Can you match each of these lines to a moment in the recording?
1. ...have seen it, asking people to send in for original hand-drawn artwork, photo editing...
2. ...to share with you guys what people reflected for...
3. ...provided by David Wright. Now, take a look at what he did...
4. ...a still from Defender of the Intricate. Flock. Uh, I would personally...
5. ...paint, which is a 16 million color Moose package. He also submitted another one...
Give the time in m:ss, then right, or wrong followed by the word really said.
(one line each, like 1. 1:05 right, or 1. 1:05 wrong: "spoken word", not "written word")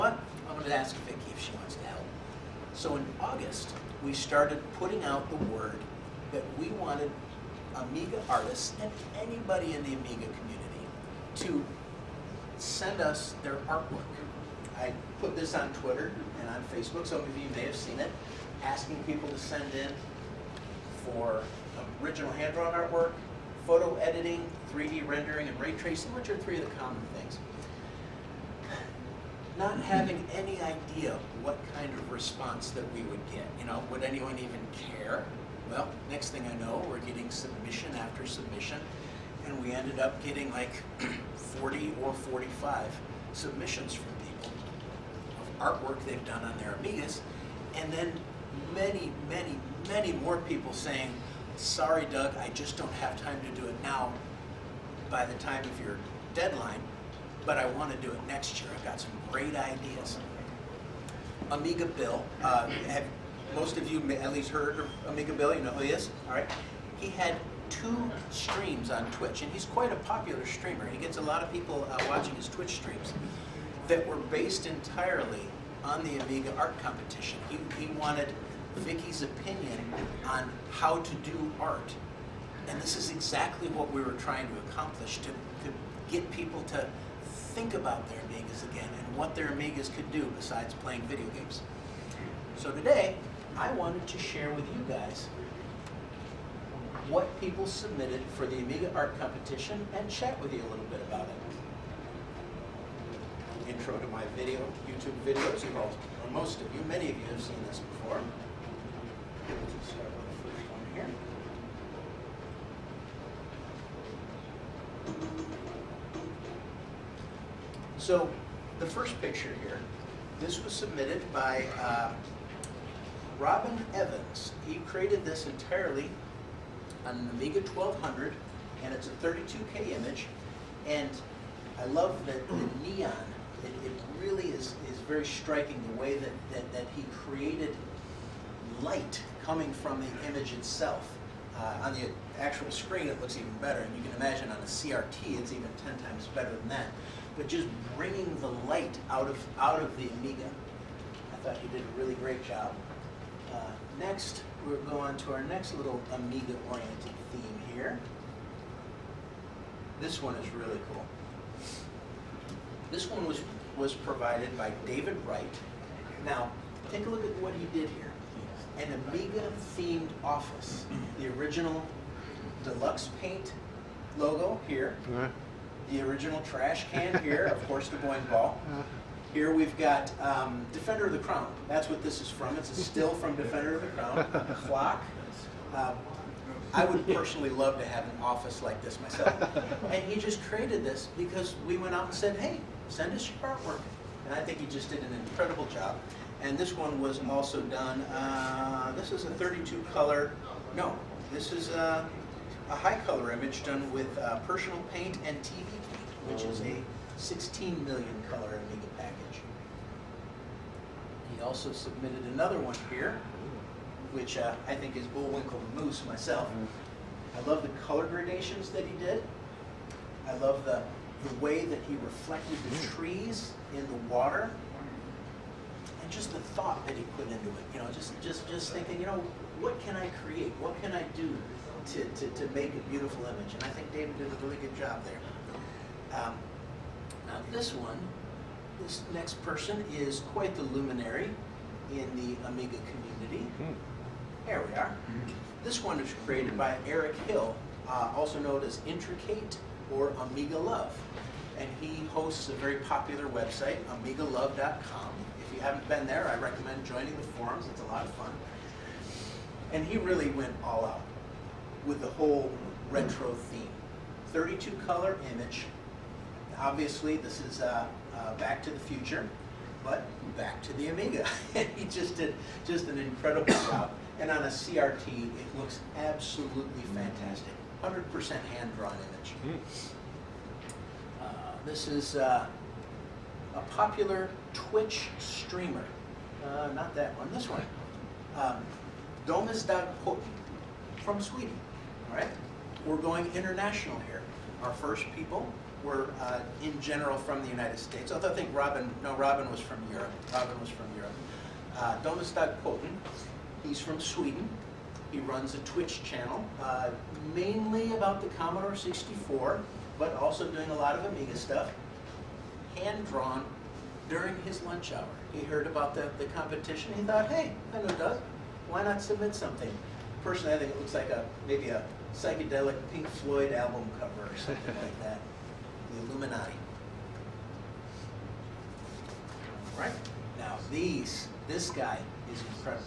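1. 0:17 right
2. 1:34 wrong: "submitted", not "reflected"
3. 2:43 right
4. 3:02 wrong: "Crown", not "Intricate"
5. 3:25 wrong: "Amiga", not "Moose".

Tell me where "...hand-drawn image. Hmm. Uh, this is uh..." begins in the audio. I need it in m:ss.
4:38.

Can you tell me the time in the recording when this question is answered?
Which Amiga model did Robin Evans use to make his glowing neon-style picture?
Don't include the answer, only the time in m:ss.
2:07.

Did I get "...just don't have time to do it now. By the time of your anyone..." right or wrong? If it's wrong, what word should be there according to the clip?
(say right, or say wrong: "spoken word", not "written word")
wrong: "deadline", not "anyone".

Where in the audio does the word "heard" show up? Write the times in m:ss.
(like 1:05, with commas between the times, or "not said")
1:04, 5:15.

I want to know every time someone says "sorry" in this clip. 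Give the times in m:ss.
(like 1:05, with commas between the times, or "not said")
0:51.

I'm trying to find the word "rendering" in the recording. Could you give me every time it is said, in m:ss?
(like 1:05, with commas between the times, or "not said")
0:25.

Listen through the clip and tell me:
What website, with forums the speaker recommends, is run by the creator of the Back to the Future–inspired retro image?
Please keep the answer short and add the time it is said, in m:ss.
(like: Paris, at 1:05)
amigalove.com, at 4:14.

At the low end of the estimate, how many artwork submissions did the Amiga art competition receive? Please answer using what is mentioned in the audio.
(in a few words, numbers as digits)
40.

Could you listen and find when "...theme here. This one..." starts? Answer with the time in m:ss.
2:37.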